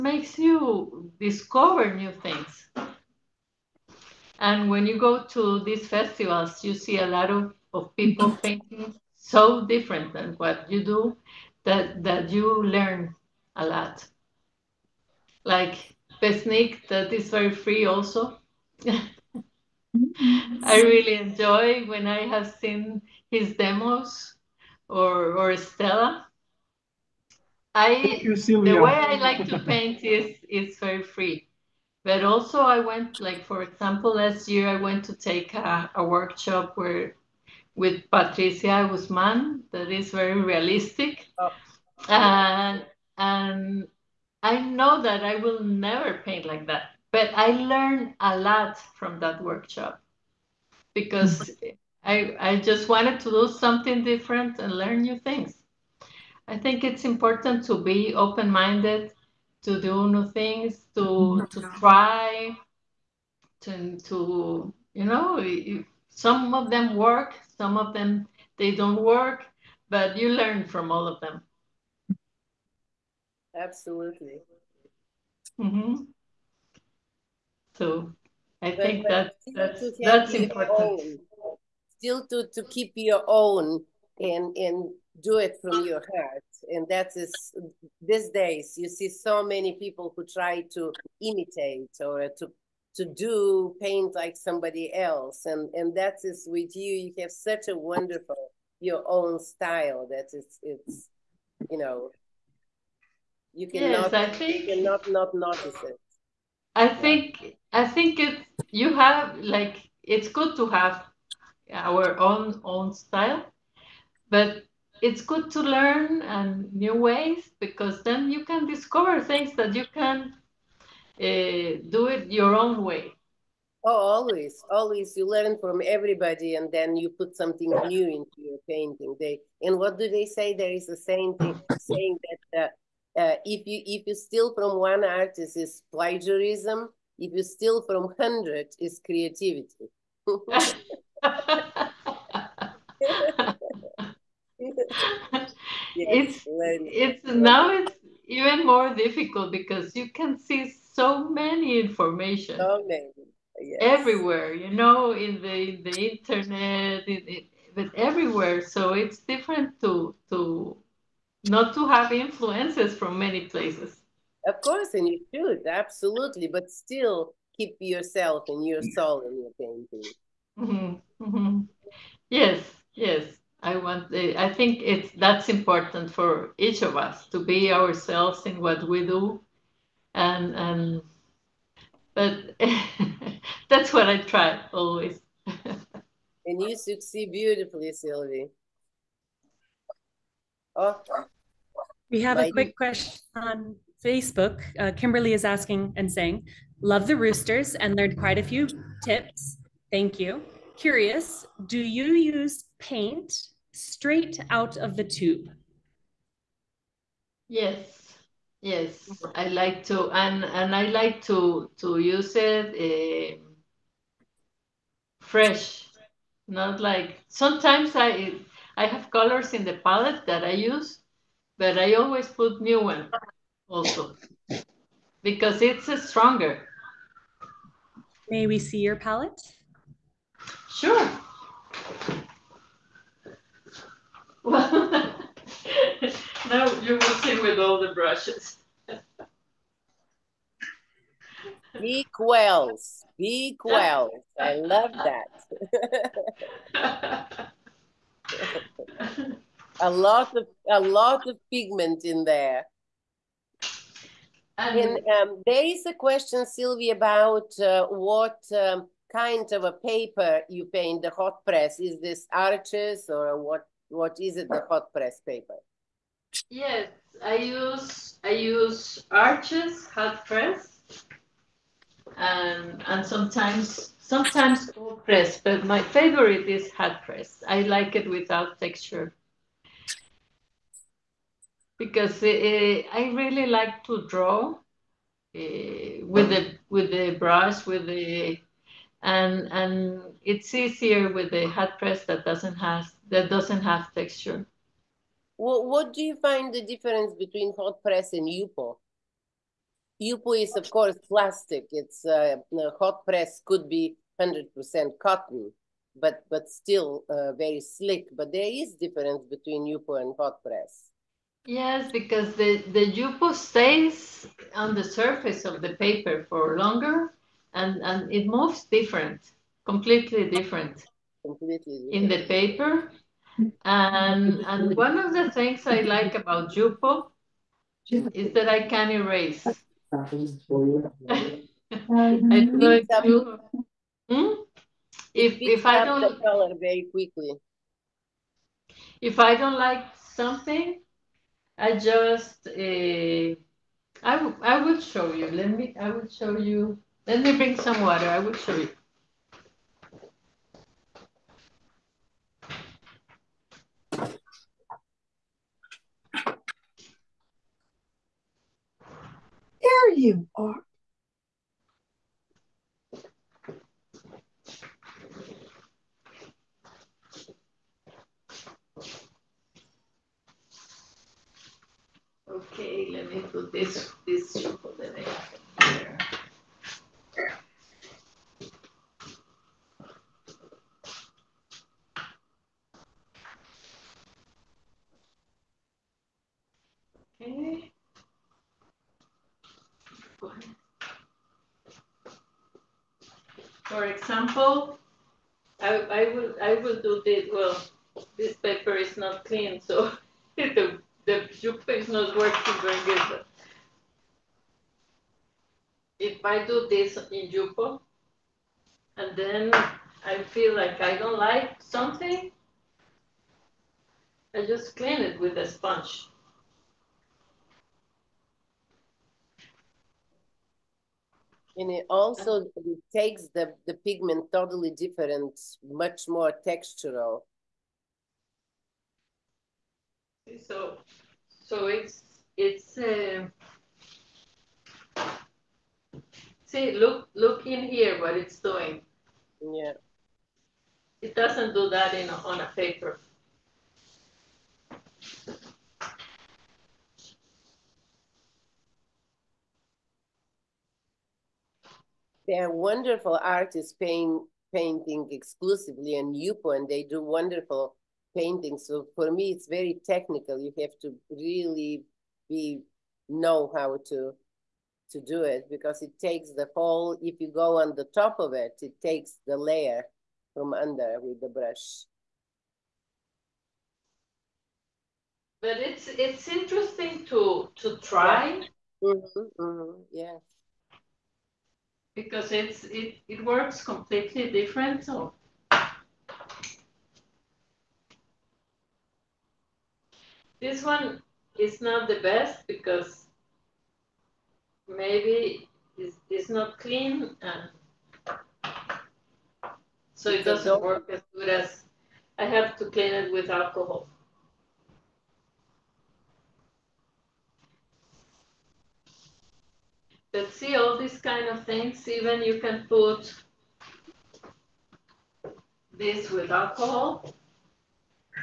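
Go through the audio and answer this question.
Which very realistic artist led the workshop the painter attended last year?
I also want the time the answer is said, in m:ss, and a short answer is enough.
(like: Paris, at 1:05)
Patricia Guzman, at 0:38.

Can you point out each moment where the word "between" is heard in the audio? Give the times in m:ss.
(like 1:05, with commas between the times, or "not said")
4:57, 5:09.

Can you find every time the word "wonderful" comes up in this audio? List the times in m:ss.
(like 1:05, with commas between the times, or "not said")
1:37, 7:32, 7:37.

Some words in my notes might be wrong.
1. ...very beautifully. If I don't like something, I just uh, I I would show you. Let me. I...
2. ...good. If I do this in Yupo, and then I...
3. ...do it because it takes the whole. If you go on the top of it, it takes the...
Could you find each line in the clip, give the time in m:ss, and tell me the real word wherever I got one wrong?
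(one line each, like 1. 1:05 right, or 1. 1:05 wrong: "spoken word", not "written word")
1. 5:36 wrong: "quickly", not "beautifully"
2. 6:43 right
3. 7:44 right.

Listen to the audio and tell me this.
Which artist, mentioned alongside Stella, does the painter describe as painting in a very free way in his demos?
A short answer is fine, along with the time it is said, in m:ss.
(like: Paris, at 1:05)
Besnik, at 0:16.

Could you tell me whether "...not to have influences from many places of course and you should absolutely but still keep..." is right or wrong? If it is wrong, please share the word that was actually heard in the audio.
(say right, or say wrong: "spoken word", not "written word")
right.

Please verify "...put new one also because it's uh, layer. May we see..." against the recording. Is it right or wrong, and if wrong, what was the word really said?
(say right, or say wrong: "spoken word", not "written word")
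wrong: "stronger", not "layer".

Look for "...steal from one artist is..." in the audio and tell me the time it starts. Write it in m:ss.
2:14.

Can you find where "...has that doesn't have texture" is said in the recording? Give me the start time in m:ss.
4:52.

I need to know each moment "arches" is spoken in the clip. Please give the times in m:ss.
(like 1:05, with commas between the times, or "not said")
4:22, 4:29.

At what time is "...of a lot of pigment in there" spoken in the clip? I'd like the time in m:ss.
4:10.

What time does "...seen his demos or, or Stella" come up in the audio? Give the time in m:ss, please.
0:22.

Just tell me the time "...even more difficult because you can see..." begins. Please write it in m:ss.
2:28.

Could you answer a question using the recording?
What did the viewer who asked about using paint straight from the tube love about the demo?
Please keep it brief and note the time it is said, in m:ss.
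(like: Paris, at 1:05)
The roosters, at 3:17.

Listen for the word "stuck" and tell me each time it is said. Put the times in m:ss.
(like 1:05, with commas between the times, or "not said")
not said.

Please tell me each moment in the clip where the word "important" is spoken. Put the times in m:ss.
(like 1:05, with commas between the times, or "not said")
0:57, 1:20, 2:55.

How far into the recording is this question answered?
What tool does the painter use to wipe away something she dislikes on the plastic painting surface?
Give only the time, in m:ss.
6:55.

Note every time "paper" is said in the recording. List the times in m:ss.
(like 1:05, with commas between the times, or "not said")
4:19, 4:25, 5:15, 5:22, 6:38, 7:22.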